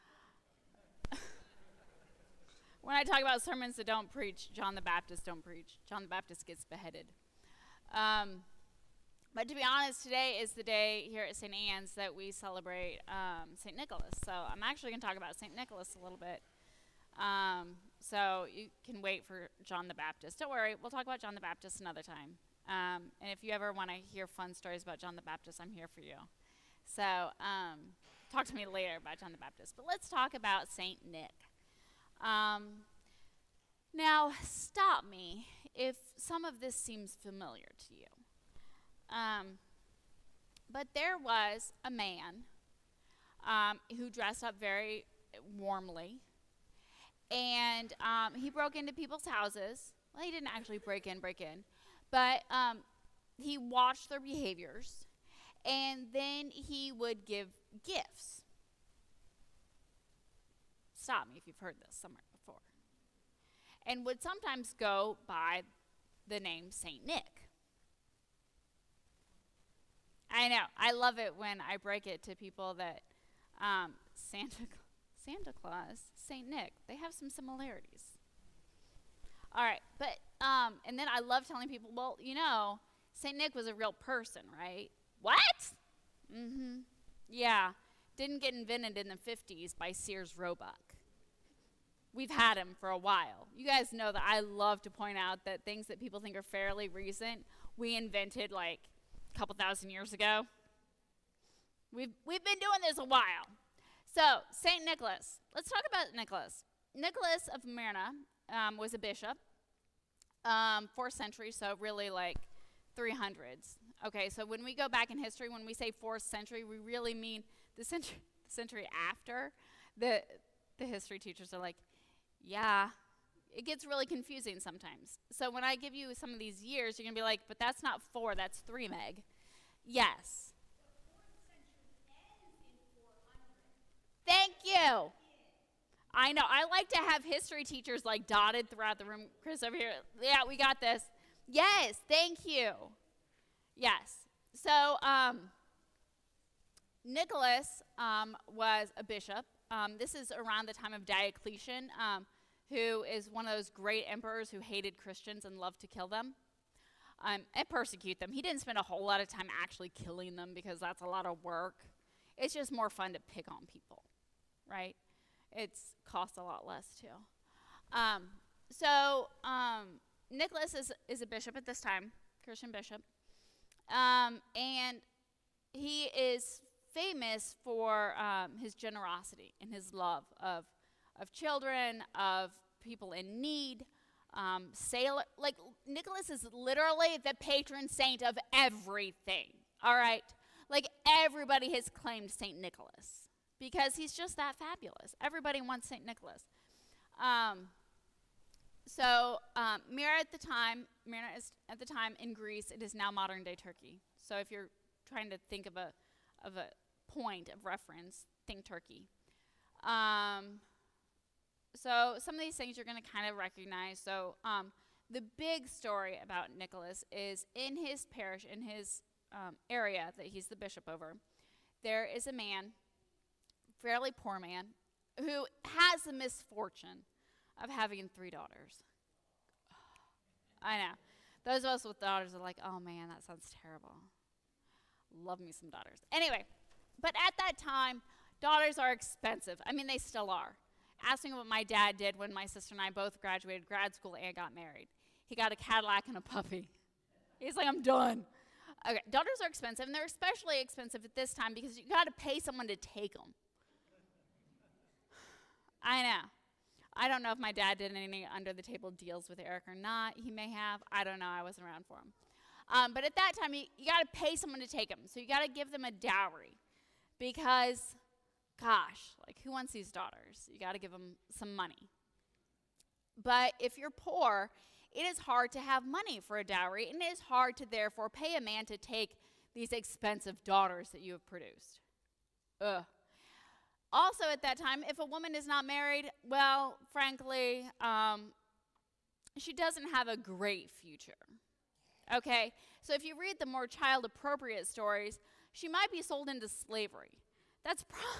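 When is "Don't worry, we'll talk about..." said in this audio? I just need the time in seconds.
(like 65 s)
20 s.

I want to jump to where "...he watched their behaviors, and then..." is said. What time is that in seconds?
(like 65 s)
53 s.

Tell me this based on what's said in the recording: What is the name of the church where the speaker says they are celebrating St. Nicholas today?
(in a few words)
St. Anne's.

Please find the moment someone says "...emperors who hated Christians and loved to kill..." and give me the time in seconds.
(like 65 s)
154 s.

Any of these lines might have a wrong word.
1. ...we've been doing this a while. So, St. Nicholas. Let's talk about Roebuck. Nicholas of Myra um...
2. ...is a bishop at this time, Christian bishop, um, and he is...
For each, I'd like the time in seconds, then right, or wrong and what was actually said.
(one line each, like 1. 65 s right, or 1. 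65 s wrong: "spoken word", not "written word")
1. 102 s wrong: "Nicholas", not "Roebuck"
2. 171 s right.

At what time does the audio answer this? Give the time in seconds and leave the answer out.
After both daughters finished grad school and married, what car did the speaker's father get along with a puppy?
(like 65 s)
245 s.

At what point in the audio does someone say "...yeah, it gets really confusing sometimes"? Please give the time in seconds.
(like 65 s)
122 s.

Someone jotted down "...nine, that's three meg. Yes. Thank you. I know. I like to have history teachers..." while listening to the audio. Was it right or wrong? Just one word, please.
wrong.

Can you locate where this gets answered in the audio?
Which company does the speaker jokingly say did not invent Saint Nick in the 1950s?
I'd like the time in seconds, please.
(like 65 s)
89 s.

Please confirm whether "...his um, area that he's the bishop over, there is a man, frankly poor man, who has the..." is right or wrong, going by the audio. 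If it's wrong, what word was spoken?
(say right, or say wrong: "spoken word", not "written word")
wrong: "fairly", not "frankly".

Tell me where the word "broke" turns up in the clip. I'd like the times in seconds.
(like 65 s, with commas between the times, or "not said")
48 s.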